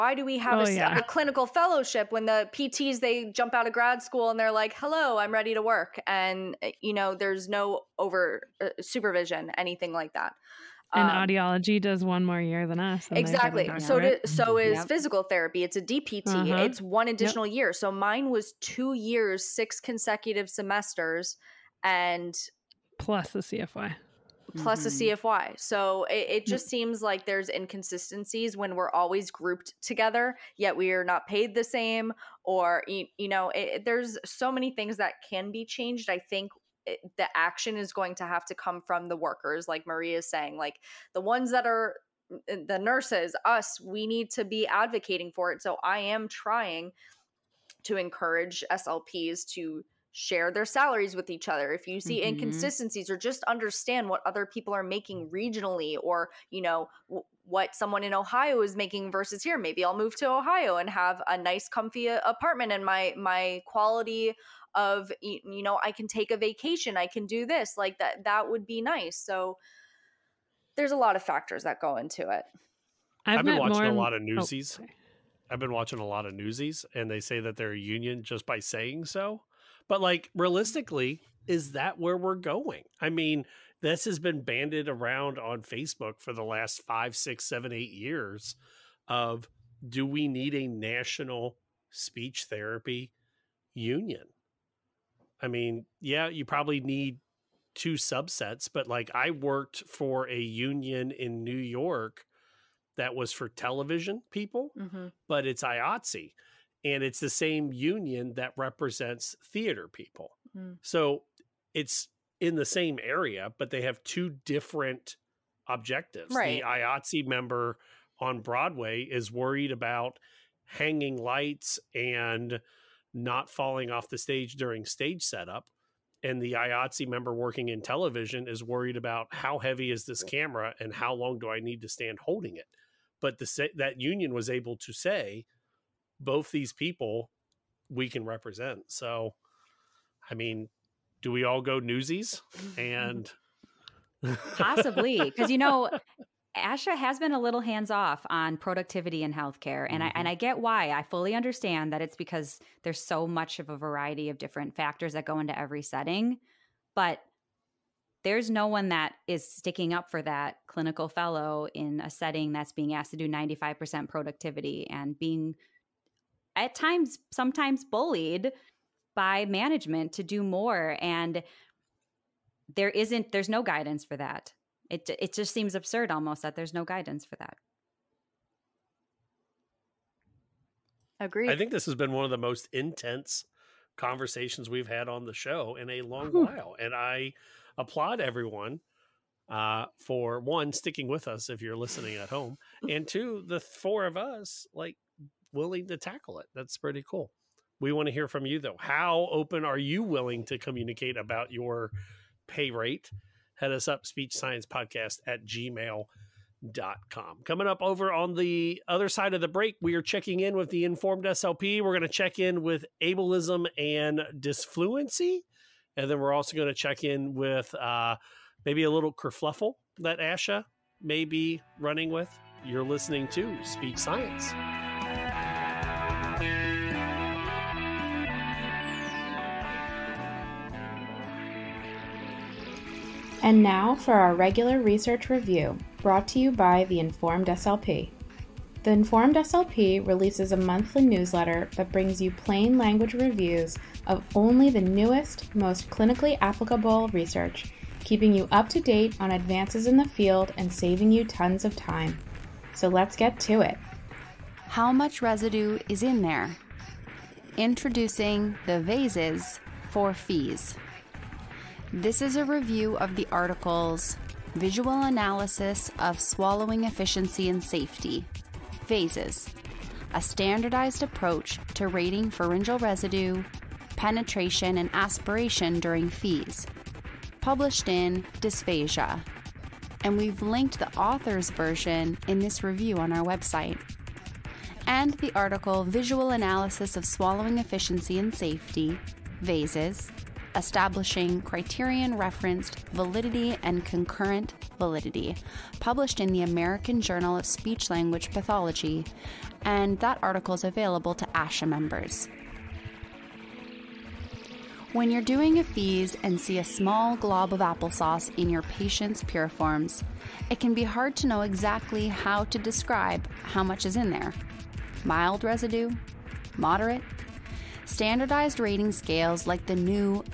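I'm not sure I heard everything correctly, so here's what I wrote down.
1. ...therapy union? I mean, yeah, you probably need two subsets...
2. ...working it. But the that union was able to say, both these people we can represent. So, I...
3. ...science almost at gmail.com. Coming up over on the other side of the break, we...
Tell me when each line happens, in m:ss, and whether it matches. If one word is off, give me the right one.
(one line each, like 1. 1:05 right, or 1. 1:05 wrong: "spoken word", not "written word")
1. 1:32 right
2. 2:12 wrong: "holding", not "working"
3. 3:24 wrong: "podcast", not "almost".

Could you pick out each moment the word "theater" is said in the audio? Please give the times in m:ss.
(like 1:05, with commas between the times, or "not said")
1:49.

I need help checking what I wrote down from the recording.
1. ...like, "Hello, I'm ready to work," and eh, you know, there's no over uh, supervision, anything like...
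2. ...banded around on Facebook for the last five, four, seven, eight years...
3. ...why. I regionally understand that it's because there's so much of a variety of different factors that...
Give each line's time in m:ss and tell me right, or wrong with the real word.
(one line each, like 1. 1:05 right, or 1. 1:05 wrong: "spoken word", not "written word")
1. 0:04 right
2. 1:24 wrong: "six", not "four"
3. 2:30 wrong: "fully", not "regionally".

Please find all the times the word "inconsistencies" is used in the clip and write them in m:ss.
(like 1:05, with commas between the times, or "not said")
0:27, 0:52.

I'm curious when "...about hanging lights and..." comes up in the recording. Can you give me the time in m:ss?
1:59.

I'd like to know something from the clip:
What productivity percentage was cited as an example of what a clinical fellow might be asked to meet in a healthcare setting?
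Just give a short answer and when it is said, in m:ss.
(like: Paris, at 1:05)
95%, at 2:43.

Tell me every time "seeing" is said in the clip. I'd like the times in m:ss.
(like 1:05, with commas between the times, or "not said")
not said.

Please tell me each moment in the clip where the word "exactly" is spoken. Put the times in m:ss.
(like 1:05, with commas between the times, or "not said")
0:13, 5:11.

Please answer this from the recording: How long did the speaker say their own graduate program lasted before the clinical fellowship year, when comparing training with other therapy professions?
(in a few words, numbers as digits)
2 years.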